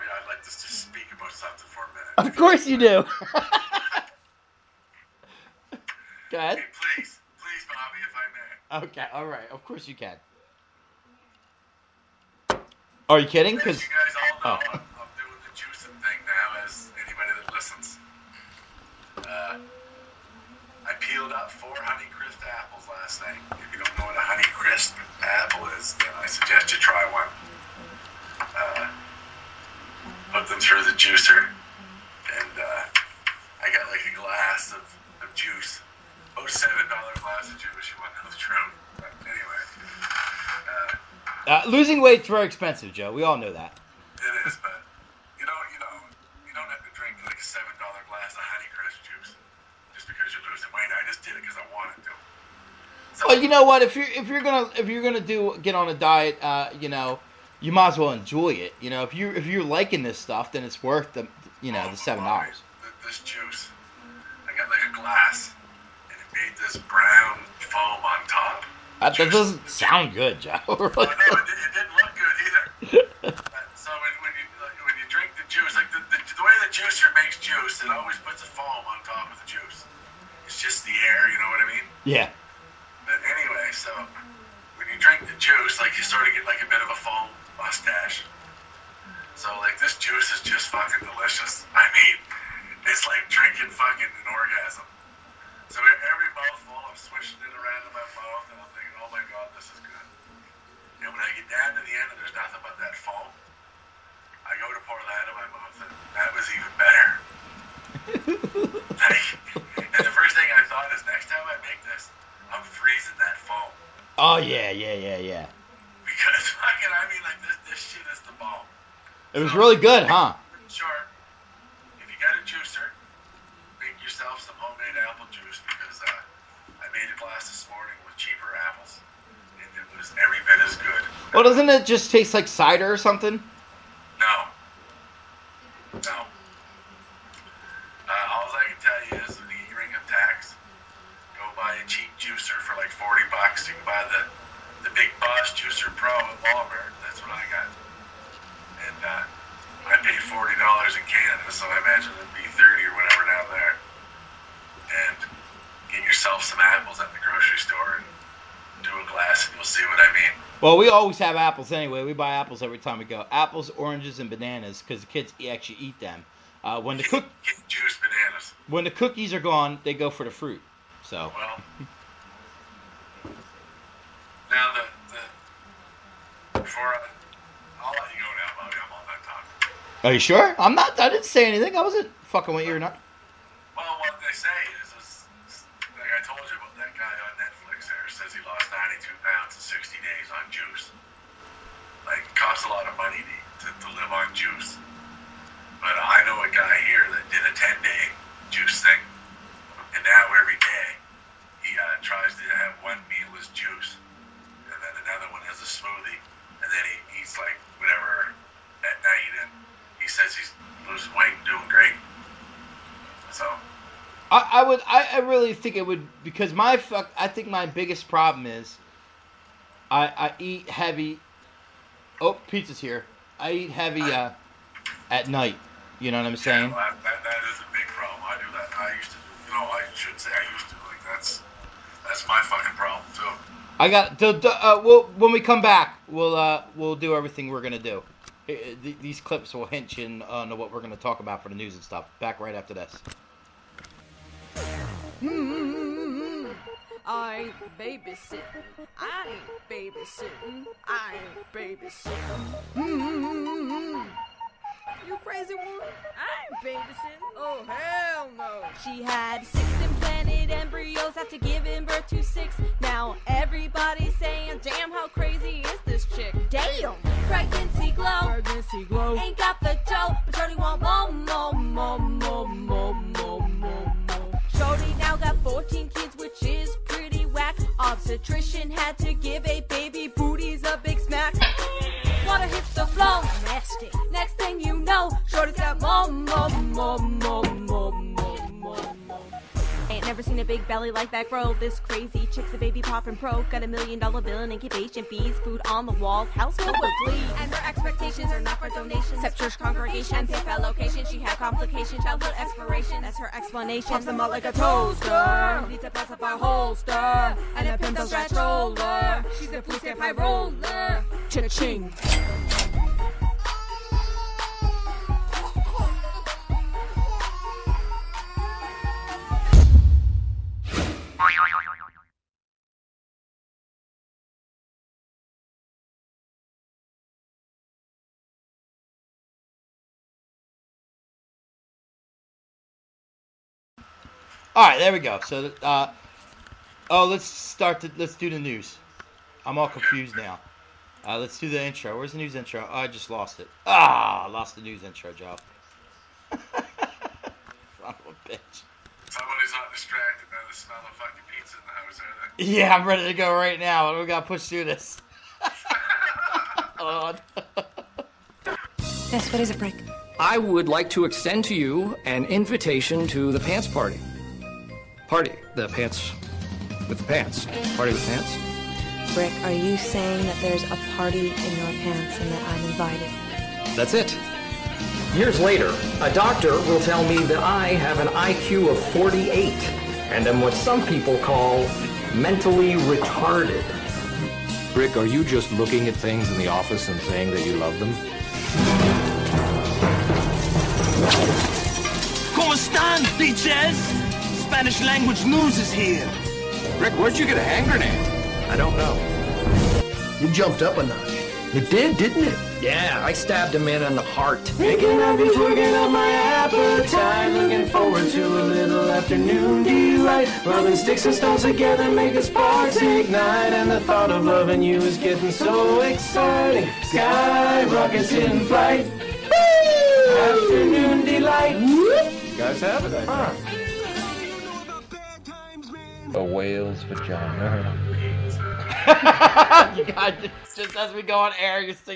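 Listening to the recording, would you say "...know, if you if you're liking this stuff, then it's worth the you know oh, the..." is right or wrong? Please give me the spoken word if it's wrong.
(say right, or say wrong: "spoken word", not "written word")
right.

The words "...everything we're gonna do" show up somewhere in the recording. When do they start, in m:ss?
3:57.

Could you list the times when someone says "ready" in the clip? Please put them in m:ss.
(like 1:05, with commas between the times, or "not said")
5:52.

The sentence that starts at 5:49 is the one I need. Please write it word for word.
Somebody's not distracted by the smell of fucking pizza in the house, are they?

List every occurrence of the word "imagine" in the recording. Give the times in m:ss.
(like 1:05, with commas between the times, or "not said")
2:31.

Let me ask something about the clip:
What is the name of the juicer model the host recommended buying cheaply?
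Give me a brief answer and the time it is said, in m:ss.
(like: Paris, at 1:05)
Big Boss Juicer Pro, at 2:24.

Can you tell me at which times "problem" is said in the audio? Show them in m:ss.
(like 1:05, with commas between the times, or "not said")
3:38, 3:47, 3:52.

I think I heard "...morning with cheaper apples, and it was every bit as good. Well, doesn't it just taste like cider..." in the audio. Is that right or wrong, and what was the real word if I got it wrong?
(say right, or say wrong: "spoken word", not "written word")
right.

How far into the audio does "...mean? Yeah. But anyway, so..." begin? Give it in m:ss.
1:21.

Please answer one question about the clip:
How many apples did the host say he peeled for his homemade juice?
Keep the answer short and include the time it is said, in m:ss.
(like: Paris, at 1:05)
4, at 0:21.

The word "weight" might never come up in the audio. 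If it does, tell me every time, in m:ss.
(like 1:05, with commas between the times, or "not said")
0:42, 0:50.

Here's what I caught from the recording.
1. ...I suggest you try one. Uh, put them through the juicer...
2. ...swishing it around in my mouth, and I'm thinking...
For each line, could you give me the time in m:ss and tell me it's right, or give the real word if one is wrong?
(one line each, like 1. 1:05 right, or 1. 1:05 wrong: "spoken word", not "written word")
1. 0:26 right
2. 1:36 right.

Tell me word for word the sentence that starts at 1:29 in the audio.
So like this juice is just fucking delicious.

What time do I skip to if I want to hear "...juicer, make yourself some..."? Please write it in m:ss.
2:02.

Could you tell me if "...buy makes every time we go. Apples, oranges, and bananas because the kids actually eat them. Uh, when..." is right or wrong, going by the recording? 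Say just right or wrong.
wrong.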